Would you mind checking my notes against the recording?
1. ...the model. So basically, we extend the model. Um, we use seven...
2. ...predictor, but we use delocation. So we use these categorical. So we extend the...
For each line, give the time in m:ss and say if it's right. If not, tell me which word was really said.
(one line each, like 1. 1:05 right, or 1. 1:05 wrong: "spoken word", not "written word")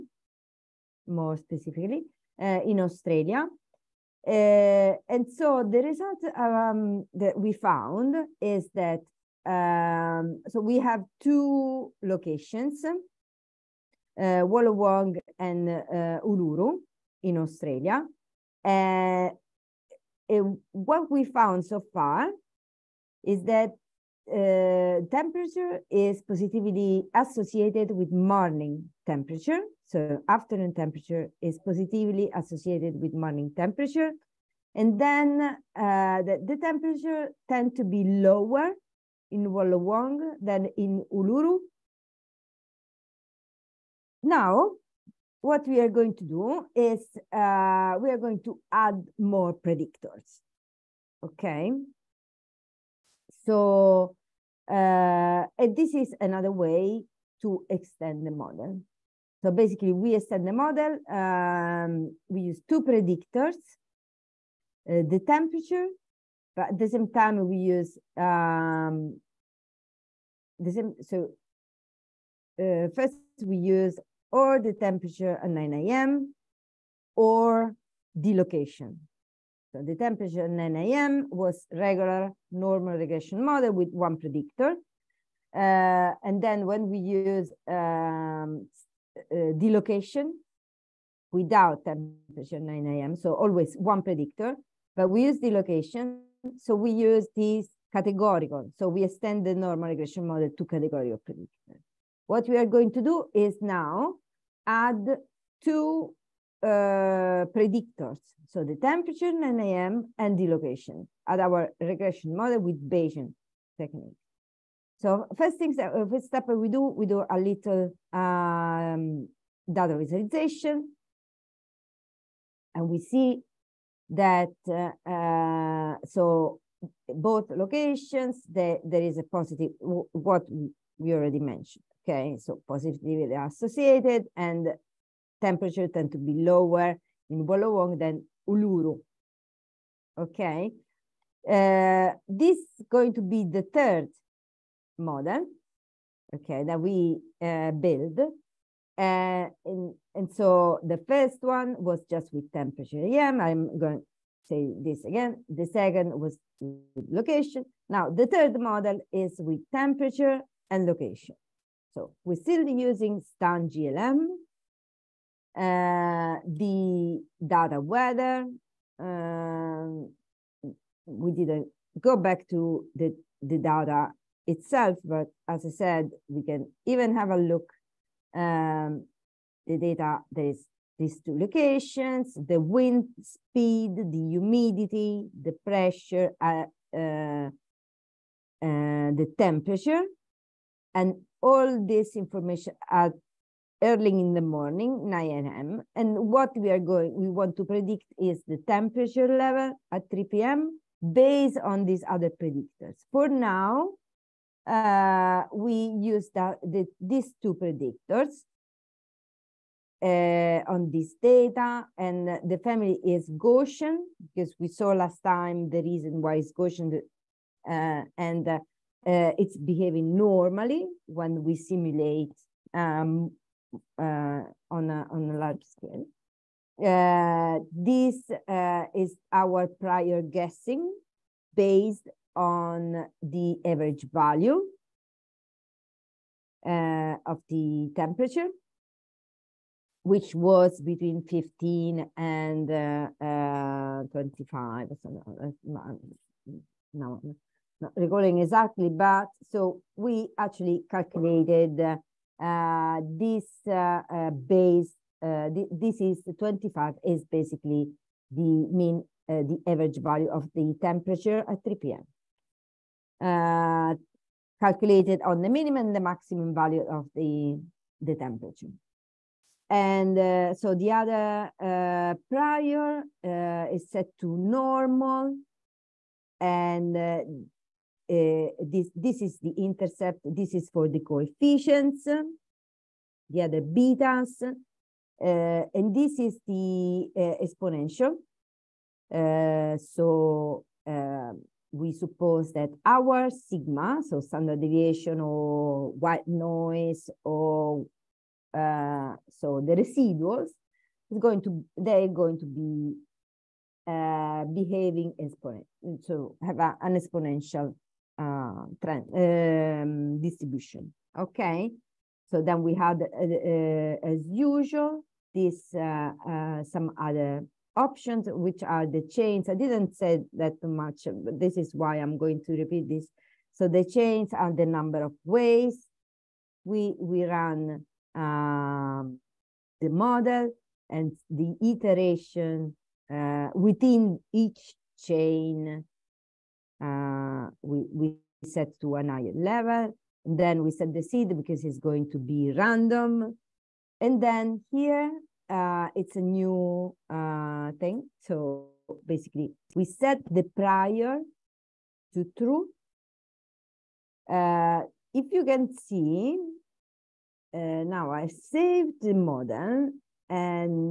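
1. 0:58 wrong: "two", not "seven"
2. 1:34 right.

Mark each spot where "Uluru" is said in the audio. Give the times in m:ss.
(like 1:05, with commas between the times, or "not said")
0:16, 0:41, 2:18.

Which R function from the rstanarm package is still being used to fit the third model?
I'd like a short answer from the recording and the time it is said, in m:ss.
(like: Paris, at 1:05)
STAN GLM, at 2:43.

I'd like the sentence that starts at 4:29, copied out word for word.
And uh, so the other uh, prior uh, is set to normal.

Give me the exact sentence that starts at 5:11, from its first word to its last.
Okay, so then we had, uh, uh as usual, this uh, uh, some other options, which are the chains.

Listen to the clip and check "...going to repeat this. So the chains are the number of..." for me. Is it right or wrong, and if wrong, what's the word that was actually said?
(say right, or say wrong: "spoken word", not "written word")
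right.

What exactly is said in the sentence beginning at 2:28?
Uh, and, and so the first one was just with temperature EM.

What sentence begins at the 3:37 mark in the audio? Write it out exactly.
Uh, and uh, it's behaving normally when we simulate um, uh, on, a, on a large scale.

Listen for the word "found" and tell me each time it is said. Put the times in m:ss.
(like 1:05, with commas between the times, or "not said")
0:07, 0:21.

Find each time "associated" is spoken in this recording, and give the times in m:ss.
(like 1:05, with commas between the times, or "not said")
0:27, 0:32, 2:13.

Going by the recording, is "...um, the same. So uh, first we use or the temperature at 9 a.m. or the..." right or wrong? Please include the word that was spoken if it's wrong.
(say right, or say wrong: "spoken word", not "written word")
right.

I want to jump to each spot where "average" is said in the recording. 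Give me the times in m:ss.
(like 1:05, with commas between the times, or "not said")
3:53, 4:19.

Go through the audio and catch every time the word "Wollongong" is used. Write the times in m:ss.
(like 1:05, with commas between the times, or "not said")
0:14, 0:39, 2:17.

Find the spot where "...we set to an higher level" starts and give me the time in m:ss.
5:37.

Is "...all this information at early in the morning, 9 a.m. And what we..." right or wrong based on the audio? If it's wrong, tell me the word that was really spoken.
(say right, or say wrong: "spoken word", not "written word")
right.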